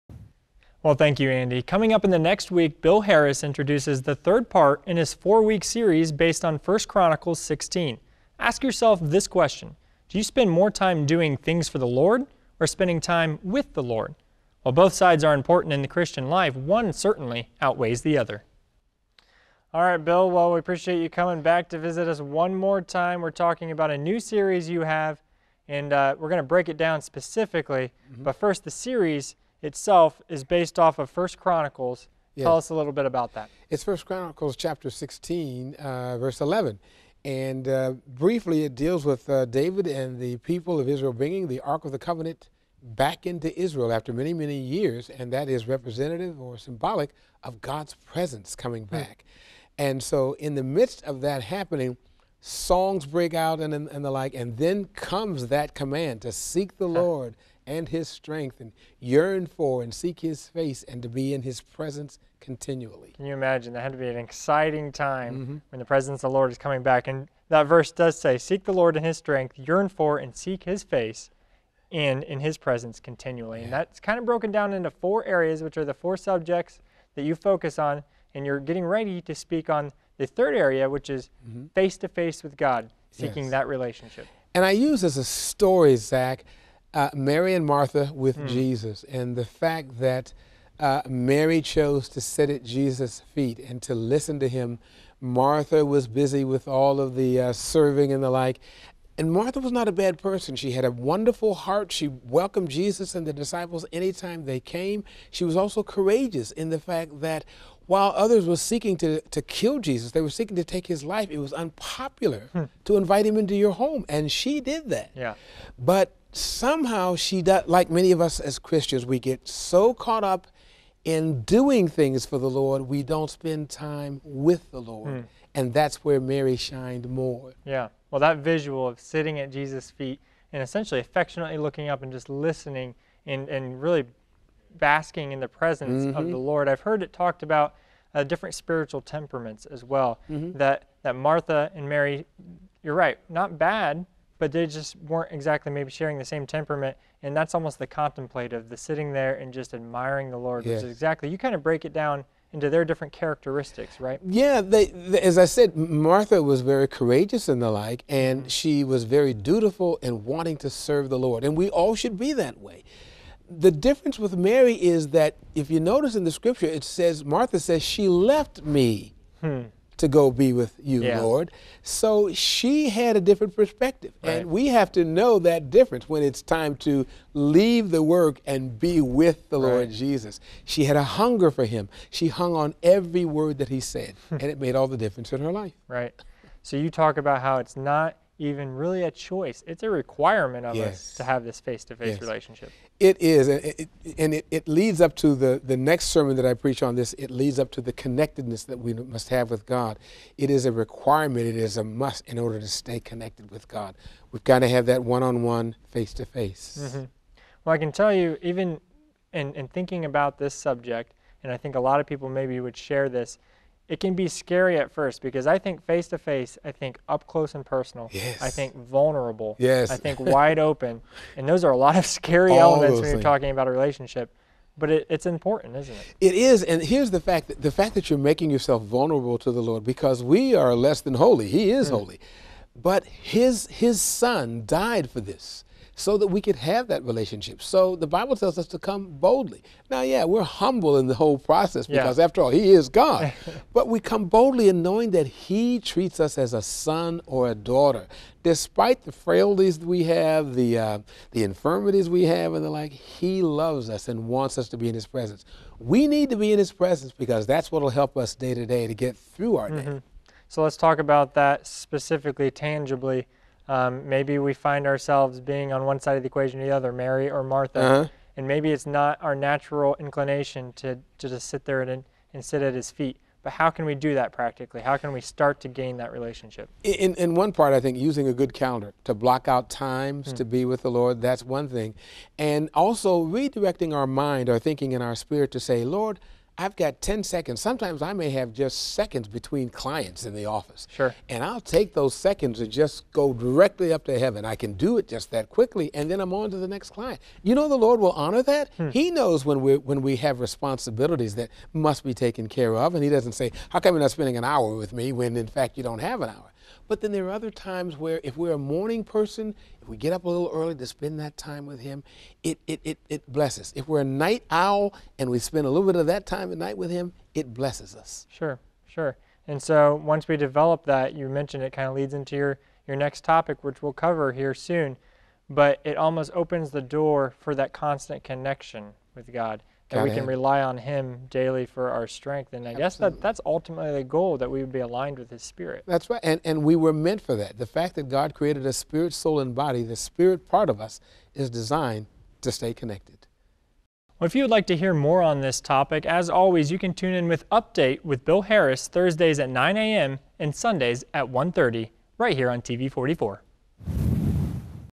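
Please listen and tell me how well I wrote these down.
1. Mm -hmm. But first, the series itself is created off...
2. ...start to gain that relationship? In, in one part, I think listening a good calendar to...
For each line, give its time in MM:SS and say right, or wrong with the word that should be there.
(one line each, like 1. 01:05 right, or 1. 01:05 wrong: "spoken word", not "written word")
1. 00:28 wrong: "based", not "created"
2. 04:35 wrong: "using", not "listening".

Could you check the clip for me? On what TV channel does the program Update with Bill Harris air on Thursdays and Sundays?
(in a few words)
TV 44.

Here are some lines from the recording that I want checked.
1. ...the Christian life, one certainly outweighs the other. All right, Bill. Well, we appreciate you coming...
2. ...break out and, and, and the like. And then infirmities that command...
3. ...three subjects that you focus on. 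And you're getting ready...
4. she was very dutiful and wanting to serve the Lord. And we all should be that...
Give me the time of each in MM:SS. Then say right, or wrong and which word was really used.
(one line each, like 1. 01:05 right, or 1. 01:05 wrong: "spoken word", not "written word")
1. 00:15 right
2. 00:53 wrong: "comes", not "infirmities"
3. 01:15 wrong: "four", not "three"
4. 02:38 right.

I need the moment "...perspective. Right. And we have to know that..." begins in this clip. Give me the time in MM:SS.
02:53.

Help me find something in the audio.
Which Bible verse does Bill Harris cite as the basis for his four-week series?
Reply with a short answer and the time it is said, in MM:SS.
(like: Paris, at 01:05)
1 Chronicles 16:11, at 00:33.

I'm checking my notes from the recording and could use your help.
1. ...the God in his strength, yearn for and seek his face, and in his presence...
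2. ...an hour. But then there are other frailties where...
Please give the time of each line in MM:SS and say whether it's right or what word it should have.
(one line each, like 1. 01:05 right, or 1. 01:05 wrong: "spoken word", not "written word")
1. 01:08 wrong: "Lord", not "God"
2. 05:06 wrong: "times", not "frailties".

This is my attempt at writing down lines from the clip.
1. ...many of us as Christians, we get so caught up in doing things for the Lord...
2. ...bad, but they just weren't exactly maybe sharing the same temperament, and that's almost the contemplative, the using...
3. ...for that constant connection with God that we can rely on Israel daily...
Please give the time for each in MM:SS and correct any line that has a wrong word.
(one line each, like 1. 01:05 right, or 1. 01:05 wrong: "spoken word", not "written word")
1. 01:57 right
2. 02:23 wrong: "sitting", not "using"
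3. 05:27 wrong: "Him", not "Israel".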